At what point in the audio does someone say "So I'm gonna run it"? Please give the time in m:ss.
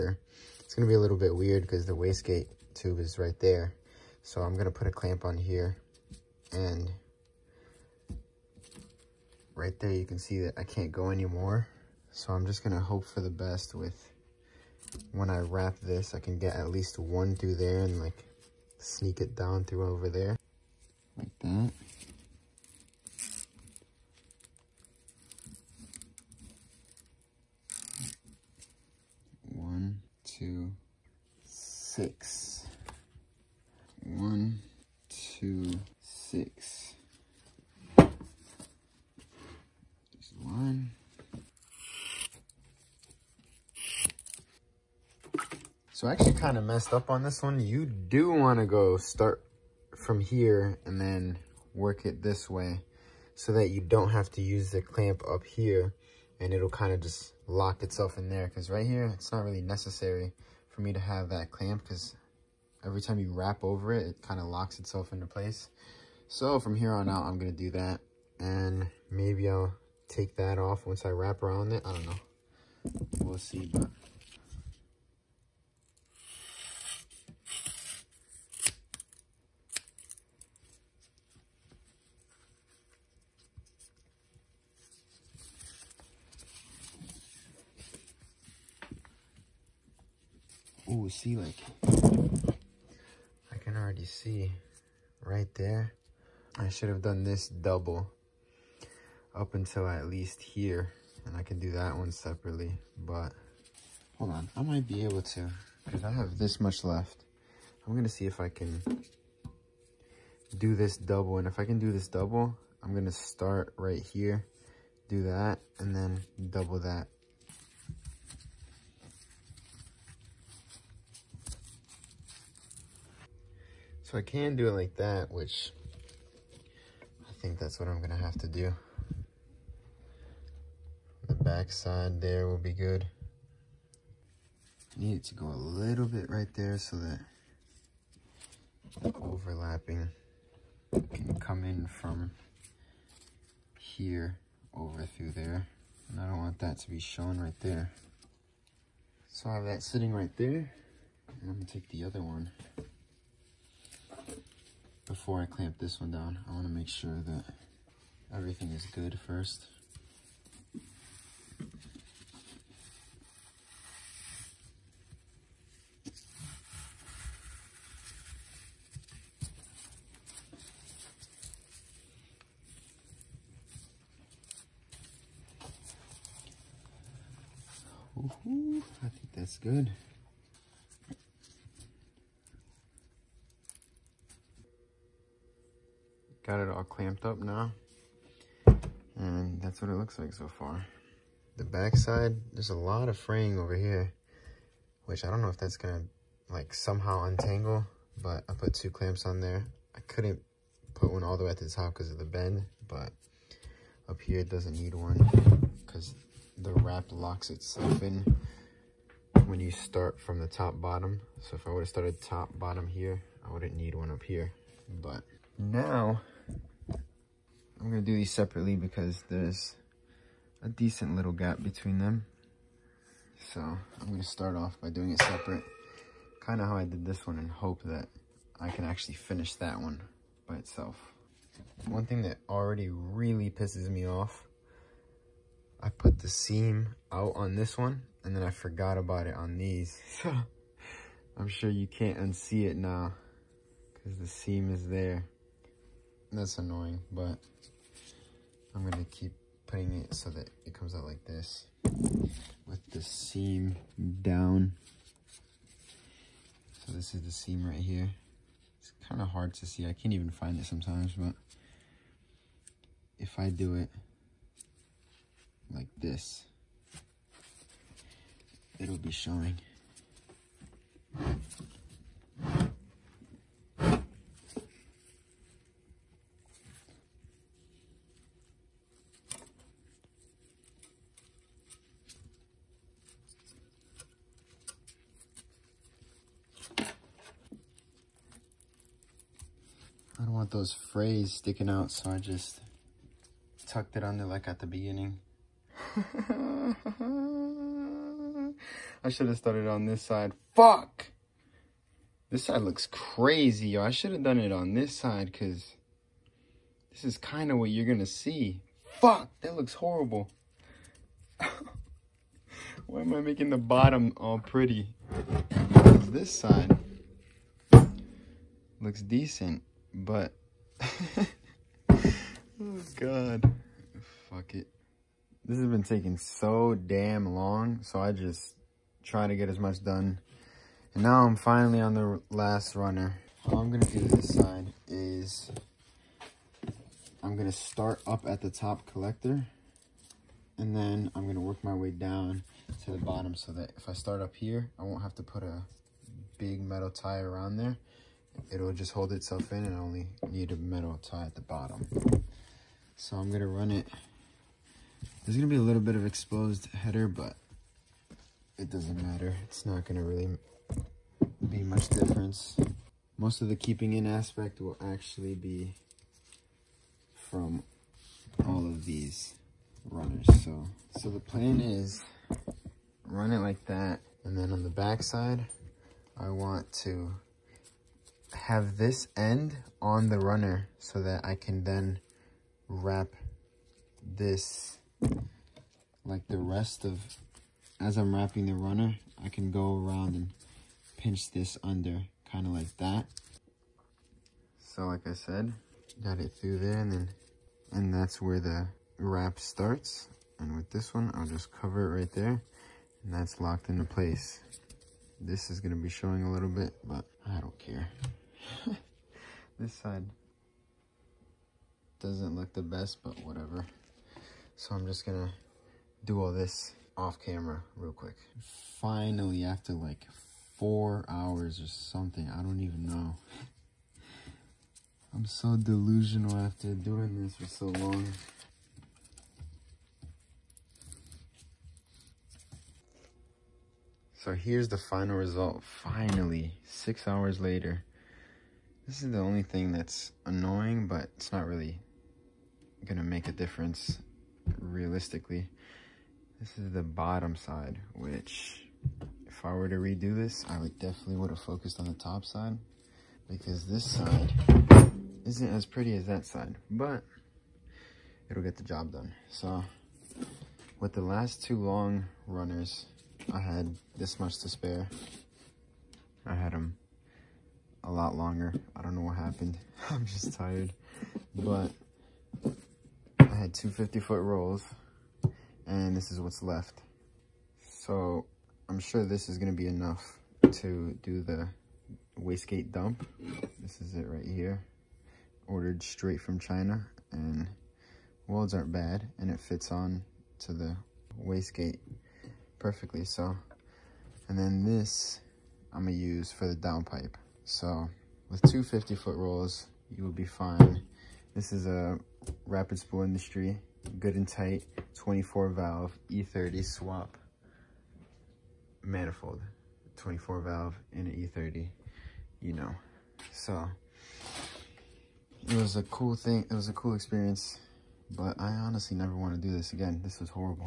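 5:52.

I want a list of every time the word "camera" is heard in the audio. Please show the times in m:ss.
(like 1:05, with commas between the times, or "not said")
6:57.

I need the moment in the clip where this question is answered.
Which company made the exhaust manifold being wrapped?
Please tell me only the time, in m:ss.
8:22.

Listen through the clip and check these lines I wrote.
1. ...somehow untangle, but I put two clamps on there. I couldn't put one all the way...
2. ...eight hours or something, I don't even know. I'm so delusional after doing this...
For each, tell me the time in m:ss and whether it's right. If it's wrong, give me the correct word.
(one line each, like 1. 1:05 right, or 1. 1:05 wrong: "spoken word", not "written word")
1. 3:16 right
2. 7:00 wrong: "four", not "eight".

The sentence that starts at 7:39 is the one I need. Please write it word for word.
So with the last two long runners, I had this much to spare.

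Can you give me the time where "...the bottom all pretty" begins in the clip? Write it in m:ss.
5:13.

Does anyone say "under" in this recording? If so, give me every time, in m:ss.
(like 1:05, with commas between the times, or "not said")
4:54, 6:31.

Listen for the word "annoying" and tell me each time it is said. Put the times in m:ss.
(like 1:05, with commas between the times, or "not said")
4:06, 7:20.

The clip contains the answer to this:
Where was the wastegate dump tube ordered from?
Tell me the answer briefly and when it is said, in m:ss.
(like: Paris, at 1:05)
China, at 8:06.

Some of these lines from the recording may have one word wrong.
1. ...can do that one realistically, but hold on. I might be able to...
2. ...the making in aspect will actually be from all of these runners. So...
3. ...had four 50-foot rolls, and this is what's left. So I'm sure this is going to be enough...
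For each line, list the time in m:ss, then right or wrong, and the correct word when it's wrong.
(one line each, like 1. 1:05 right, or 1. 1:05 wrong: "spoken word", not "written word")
1. 1:41 wrong: "separately", not "realistically"
2. 6:03 wrong: "keeping", not "making"
3. 7:53 wrong: "two", not "four".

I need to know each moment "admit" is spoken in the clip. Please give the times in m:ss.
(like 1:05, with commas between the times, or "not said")
not said.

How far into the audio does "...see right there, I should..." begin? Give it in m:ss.
1:34.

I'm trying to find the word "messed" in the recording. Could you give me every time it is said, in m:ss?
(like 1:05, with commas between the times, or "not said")
0:46.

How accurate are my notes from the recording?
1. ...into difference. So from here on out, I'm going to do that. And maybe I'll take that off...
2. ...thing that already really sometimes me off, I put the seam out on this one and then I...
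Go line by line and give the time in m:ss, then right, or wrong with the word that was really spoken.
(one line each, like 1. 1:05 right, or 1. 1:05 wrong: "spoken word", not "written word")
1. 1:05 wrong: "place", not "difference"
2. 3:52 wrong: "pisses", not "sometimes".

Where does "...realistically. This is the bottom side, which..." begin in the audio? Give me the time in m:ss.
7:24.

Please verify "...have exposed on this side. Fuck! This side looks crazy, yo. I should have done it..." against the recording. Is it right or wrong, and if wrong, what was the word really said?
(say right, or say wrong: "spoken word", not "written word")
wrong: "started", not "exposed".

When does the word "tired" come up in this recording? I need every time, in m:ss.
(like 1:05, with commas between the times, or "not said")
7:50.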